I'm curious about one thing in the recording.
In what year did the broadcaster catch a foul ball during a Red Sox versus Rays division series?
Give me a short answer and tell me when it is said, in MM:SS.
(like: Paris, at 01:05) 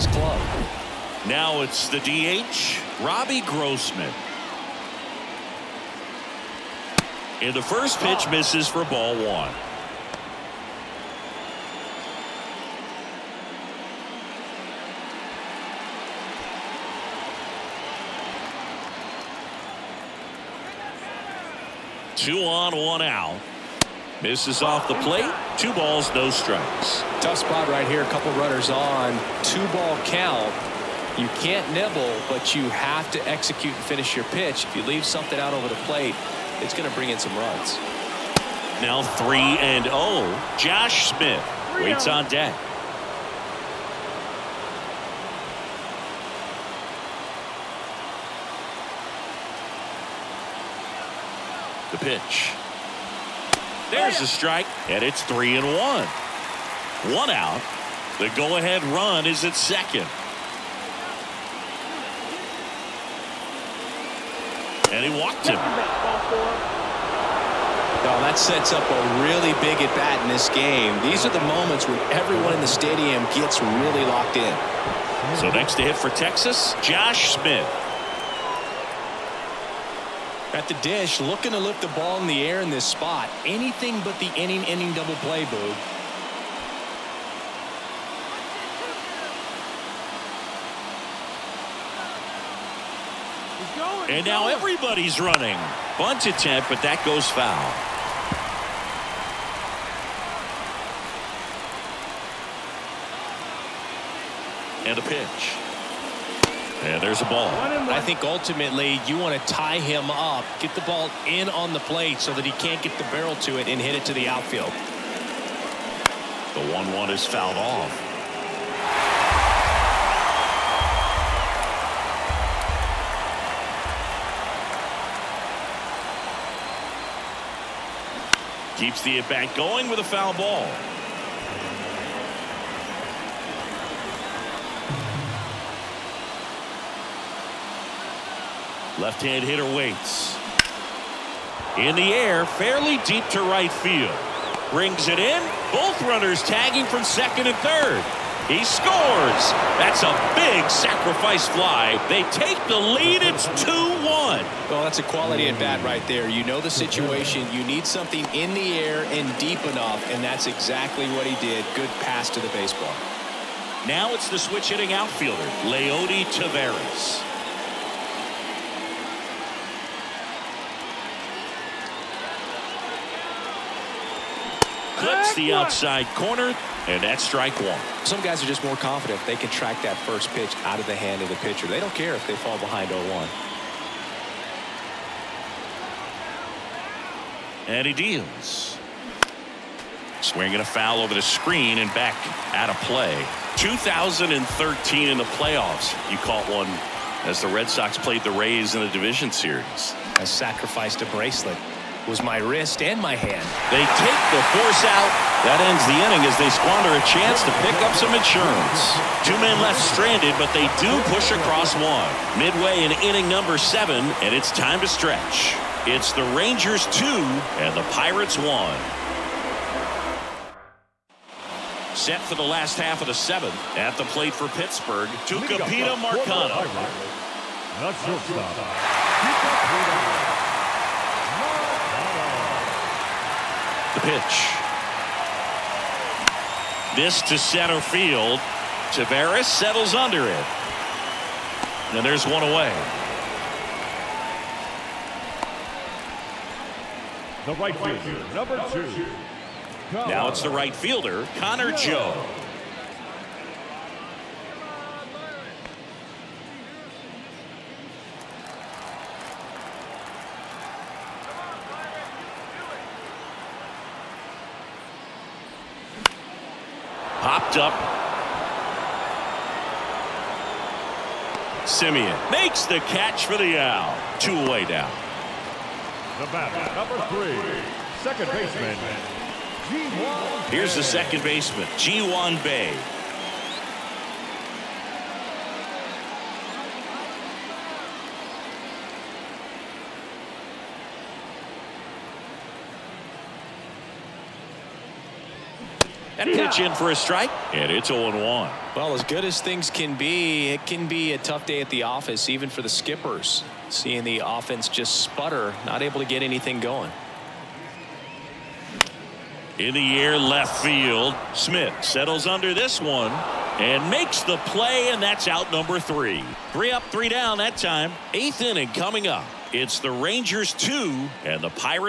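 2013, at 03:13.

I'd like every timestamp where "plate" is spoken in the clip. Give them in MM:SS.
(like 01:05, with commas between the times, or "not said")
00:25, 00:35, 01:51, 03:44.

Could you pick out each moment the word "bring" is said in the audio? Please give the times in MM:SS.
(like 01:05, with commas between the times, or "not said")
00:36, 02:24.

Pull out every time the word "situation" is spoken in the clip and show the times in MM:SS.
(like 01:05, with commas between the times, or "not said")
02:36.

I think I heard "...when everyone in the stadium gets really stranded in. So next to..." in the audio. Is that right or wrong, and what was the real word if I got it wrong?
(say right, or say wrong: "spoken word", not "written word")
wrong: "locked", not "stranded".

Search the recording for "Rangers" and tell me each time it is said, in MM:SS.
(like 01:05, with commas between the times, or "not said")
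03:36, 05:19.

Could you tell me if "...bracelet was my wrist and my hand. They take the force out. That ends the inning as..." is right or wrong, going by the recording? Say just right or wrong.
right.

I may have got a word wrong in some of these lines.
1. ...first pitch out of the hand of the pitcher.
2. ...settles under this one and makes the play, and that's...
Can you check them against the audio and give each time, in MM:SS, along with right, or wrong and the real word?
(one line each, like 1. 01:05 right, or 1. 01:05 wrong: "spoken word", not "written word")
1. 02:59 right
2. 05:11 right.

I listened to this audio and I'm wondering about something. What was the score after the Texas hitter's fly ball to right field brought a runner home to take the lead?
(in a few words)
2-1.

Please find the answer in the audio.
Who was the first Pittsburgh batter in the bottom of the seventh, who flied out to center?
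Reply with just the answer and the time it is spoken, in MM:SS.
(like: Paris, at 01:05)
Tucupita Marcano, at 03:45.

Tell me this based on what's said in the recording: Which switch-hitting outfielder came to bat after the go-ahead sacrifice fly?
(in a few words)
Leody Taveras.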